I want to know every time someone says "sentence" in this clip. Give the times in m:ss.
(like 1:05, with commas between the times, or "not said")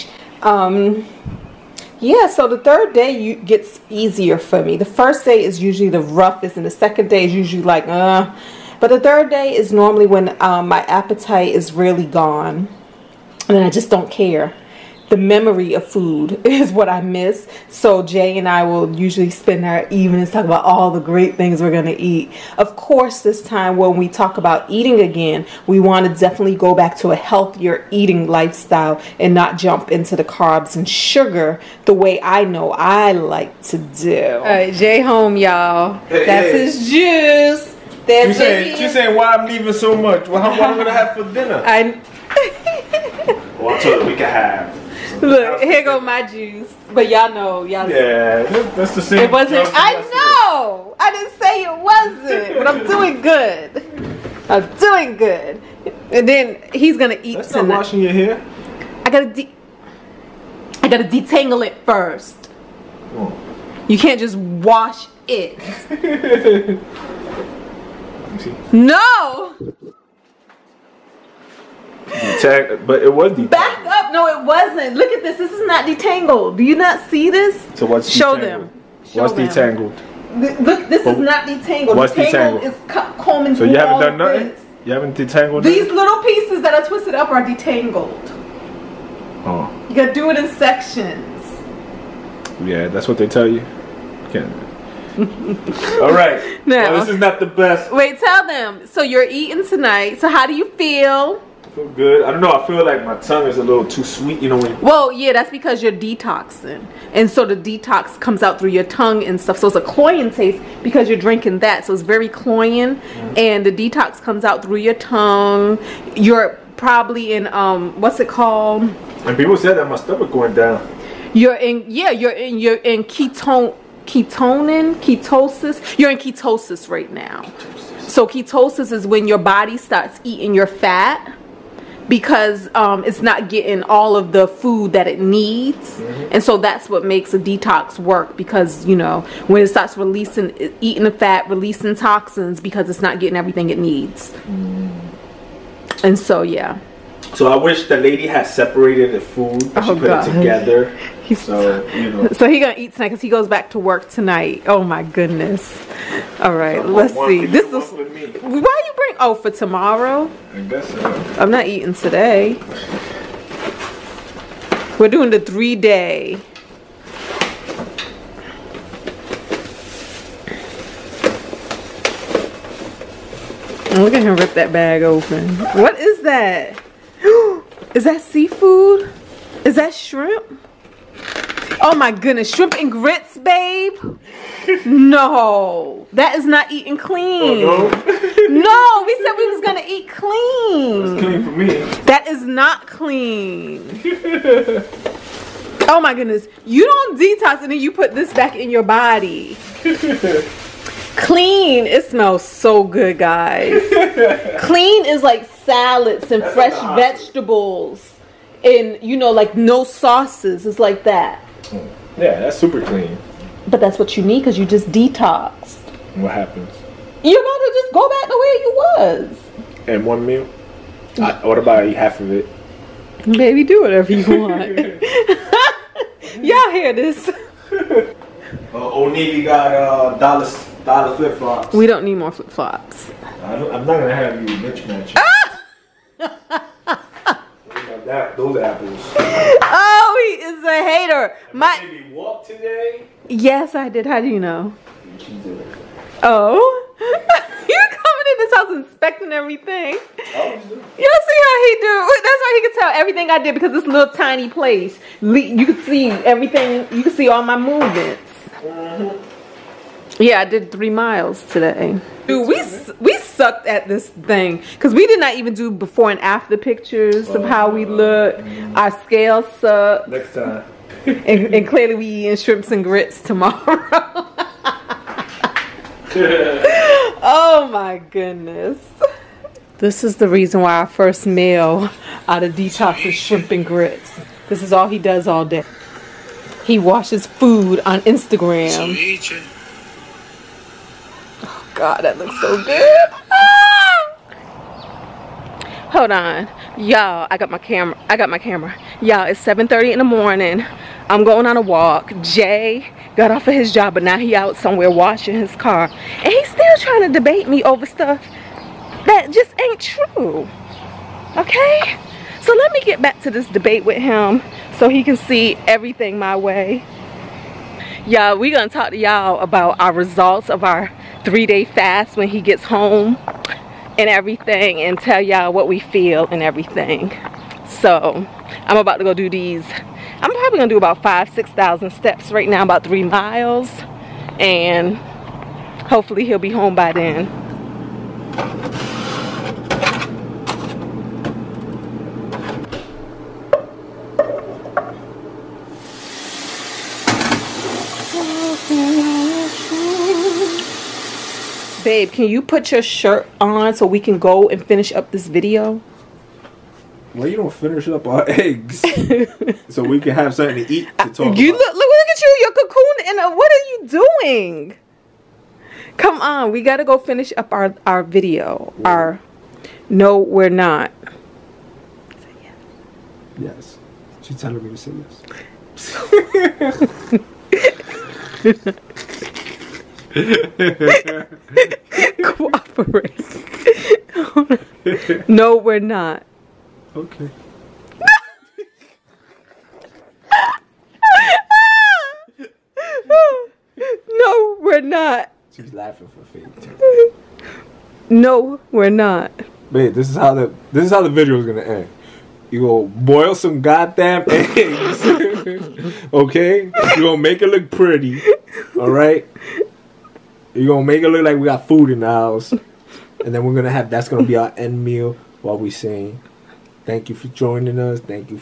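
not said.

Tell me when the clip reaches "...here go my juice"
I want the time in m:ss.
0:45.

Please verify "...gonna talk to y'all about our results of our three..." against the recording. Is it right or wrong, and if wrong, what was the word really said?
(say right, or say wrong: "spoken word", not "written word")
right.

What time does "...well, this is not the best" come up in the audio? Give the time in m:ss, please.
1:36.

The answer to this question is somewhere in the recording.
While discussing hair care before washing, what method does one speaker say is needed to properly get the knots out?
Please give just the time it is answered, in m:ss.
1:30.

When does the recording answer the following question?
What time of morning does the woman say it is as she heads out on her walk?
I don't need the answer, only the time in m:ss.
4:59.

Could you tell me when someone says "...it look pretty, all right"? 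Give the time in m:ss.
6:47.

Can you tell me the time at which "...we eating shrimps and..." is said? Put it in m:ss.
4:31.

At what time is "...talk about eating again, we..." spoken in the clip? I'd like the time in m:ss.
0:24.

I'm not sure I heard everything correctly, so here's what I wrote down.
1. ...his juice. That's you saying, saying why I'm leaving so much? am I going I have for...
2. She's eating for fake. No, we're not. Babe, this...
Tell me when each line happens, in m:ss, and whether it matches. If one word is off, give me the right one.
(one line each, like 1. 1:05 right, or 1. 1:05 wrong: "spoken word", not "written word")
1. 0:36 right
2. 6:35 wrong: "laughing", not "eating".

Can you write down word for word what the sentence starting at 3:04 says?
no, that is not eating clean.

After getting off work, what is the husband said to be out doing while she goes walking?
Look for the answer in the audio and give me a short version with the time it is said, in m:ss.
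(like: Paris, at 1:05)
washing his car, at 5:04.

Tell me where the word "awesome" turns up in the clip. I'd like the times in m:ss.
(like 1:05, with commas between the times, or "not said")
3:26.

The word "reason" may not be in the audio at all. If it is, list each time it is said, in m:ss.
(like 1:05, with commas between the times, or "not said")
4:40.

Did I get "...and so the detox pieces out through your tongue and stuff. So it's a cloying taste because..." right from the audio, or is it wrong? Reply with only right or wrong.
wrong.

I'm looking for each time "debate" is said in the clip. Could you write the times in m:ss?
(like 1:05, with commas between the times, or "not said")
5:07, 5:13.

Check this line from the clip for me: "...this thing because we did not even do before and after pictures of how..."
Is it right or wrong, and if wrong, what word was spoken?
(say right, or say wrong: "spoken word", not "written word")
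right.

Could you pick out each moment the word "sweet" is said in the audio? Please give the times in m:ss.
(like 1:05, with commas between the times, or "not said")
1:44.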